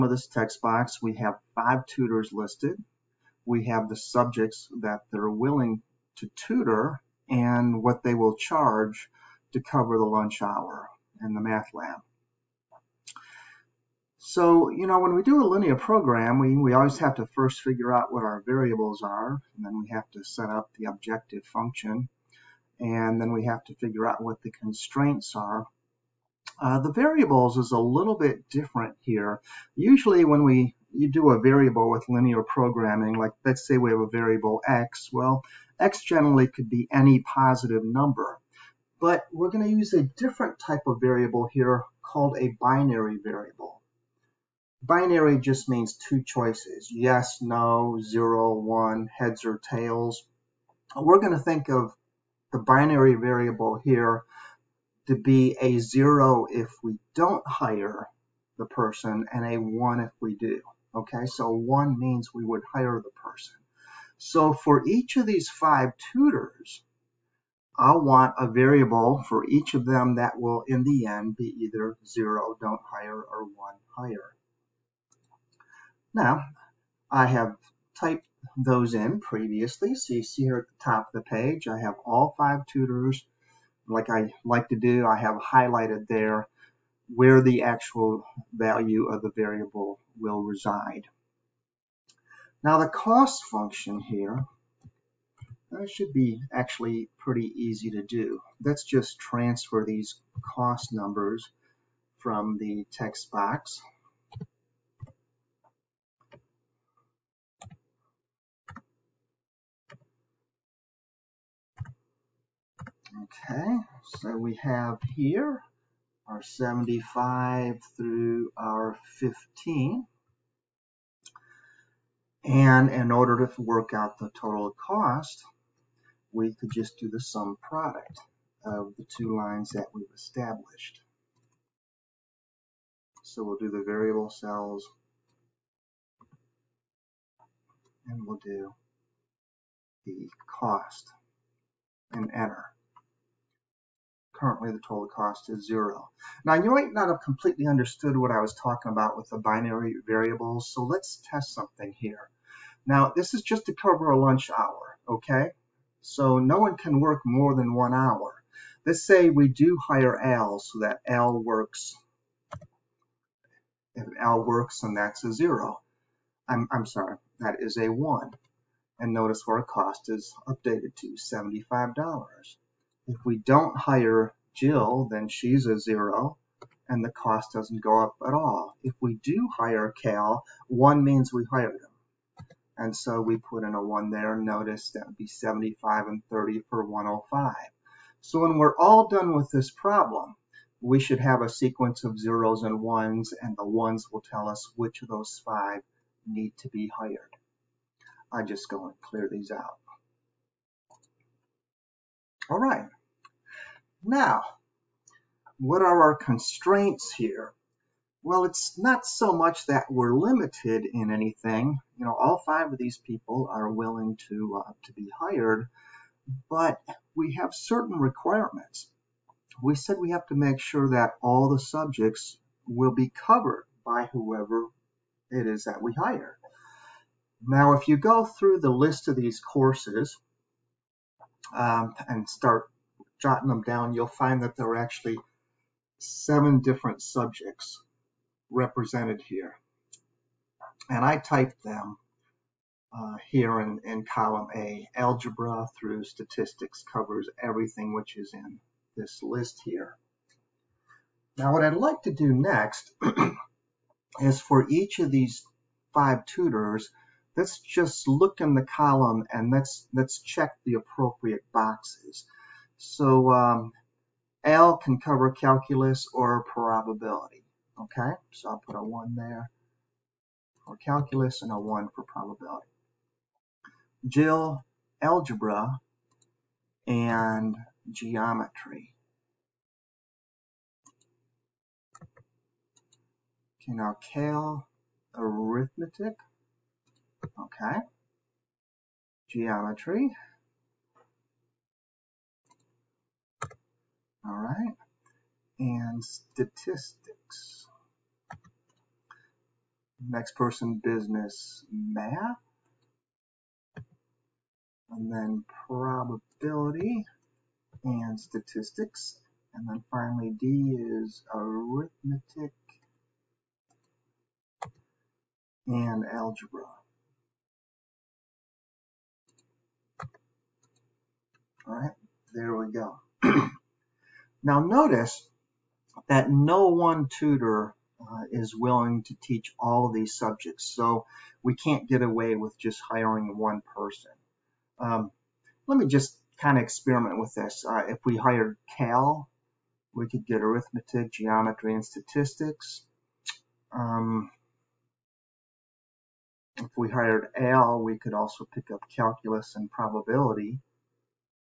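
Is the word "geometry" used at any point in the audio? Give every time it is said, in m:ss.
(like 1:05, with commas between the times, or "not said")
4:37, 4:49, 5:41.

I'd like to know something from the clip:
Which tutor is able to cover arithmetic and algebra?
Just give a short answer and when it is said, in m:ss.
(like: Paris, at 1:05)
Dee, at 5:10.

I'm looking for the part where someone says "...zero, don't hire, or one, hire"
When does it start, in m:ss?
1:12.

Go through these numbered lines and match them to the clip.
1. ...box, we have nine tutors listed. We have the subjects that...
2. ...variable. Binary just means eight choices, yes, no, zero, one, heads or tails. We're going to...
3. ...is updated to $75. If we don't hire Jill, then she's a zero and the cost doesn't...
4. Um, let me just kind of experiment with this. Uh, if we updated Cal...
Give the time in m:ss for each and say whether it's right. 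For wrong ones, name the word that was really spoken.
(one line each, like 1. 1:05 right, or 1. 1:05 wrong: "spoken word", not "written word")
1. 0:00 wrong: "five", not "nine"
2. 0:43 wrong: "two", not "eight"
3. 2:50 right
4. 5:34 wrong: "hired", not "updated".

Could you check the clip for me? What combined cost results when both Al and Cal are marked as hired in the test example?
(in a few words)
105.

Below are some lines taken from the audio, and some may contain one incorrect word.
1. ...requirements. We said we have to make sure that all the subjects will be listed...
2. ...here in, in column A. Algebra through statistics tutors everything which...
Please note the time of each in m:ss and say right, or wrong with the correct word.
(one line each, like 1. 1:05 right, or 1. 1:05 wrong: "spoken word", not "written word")
1. 3:37 wrong: "covered", not "listed"
2. 4:03 wrong: "covers", not "tutors".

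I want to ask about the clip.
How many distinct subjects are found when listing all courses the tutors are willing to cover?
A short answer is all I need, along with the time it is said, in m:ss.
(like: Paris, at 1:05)
7, at 3:55.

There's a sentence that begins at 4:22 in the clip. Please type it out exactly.
So um, Al can cover calculus or probability.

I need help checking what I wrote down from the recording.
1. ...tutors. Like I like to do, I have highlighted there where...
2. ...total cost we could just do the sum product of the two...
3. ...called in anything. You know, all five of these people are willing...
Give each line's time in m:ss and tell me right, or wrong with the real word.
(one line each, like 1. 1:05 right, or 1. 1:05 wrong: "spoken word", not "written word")
1. 1:22 right
2. 2:04 right
3. 3:30 wrong: "limited", not "called".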